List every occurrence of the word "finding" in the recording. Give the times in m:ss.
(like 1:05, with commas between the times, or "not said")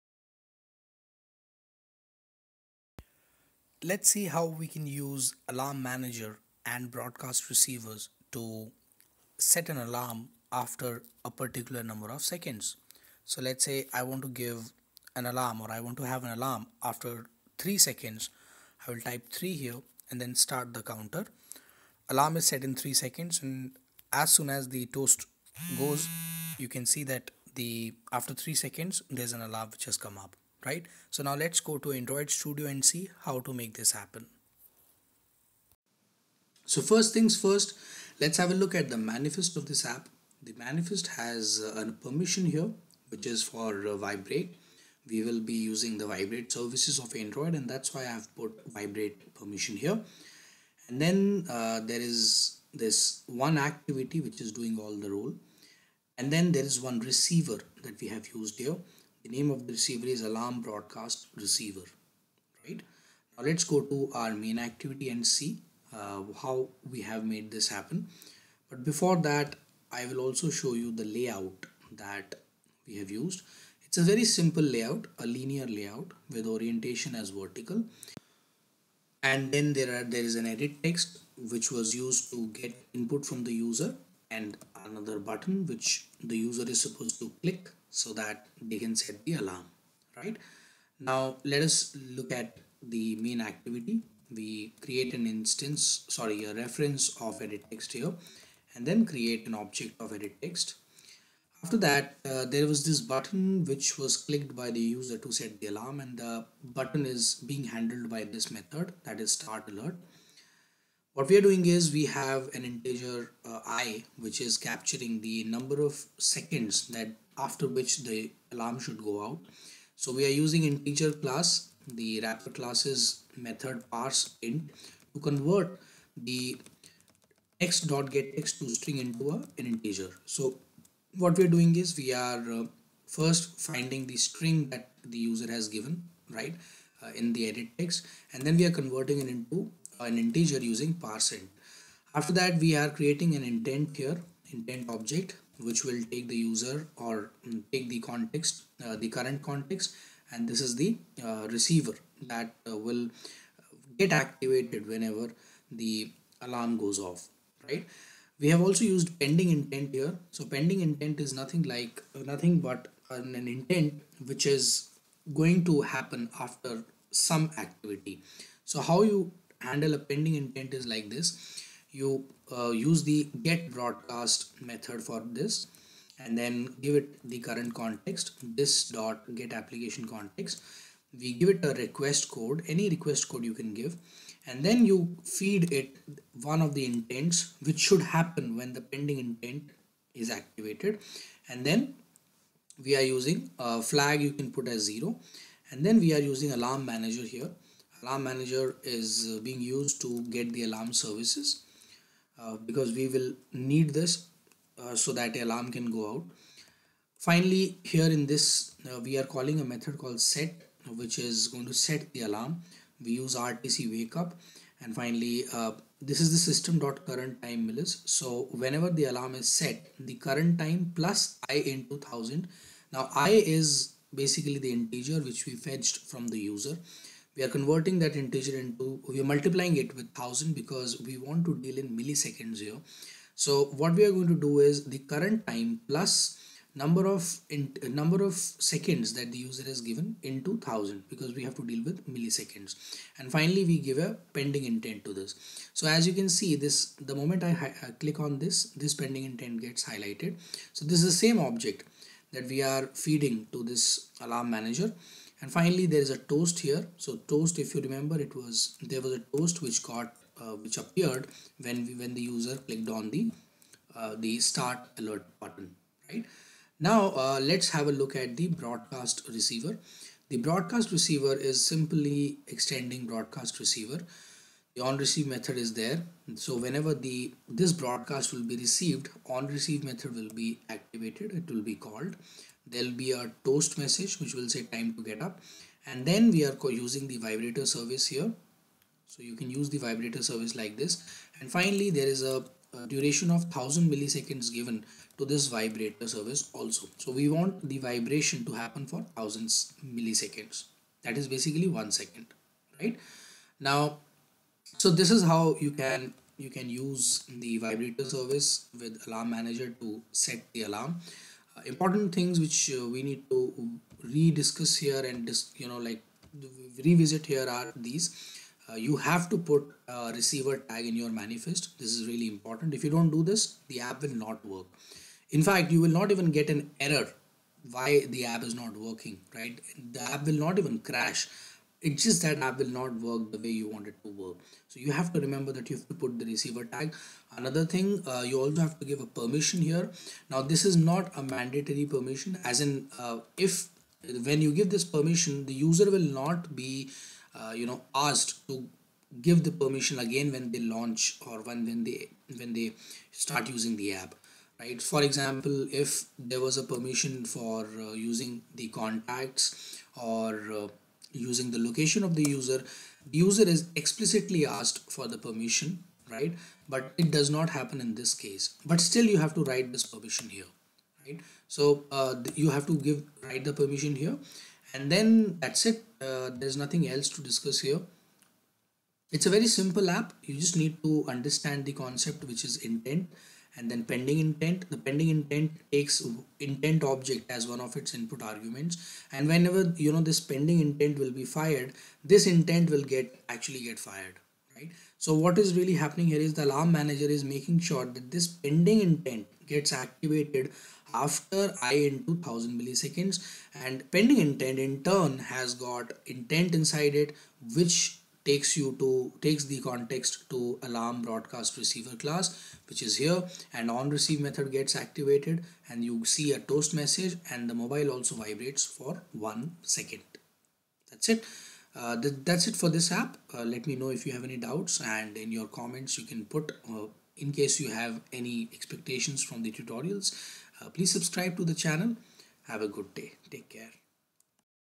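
2:13.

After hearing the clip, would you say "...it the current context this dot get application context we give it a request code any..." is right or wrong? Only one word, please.
right.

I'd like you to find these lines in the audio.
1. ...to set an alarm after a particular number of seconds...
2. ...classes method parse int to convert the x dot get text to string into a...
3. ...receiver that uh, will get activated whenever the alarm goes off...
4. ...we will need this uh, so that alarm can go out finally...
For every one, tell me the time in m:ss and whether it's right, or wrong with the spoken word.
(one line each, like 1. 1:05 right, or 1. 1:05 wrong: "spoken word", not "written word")
1. 0:08 right
2. 2:02 right
3. 2:31 right
4. 3:22 right.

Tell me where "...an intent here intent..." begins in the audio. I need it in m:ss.
2:23.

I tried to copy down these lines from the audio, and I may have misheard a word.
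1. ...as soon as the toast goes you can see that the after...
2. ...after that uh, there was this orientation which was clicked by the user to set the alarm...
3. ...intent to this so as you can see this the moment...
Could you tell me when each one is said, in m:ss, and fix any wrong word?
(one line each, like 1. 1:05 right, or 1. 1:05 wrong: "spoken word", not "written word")
1. 0:24 right
2. 1:41 wrong: "button", not "orientation"
3. 4:04 right.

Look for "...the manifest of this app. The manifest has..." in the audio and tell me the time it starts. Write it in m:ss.
0:38.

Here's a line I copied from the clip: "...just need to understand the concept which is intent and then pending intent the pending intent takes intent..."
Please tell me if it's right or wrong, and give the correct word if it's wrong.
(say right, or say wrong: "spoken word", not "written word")
right.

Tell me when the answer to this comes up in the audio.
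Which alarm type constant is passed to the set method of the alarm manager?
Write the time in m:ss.
3:33.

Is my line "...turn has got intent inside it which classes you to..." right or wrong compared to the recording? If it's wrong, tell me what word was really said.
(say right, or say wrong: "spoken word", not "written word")
wrong: "takes", not "classes".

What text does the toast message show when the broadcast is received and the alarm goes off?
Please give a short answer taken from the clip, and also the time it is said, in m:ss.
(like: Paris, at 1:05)
time to get up, at 4:44.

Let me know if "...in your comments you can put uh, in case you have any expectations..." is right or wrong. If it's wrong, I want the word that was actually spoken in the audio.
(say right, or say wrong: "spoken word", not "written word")
right.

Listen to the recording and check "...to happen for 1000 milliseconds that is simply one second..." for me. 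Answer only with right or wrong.
wrong.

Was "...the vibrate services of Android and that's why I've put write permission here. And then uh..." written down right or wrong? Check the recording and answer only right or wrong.
wrong.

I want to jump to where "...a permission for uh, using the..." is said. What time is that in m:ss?
5:56.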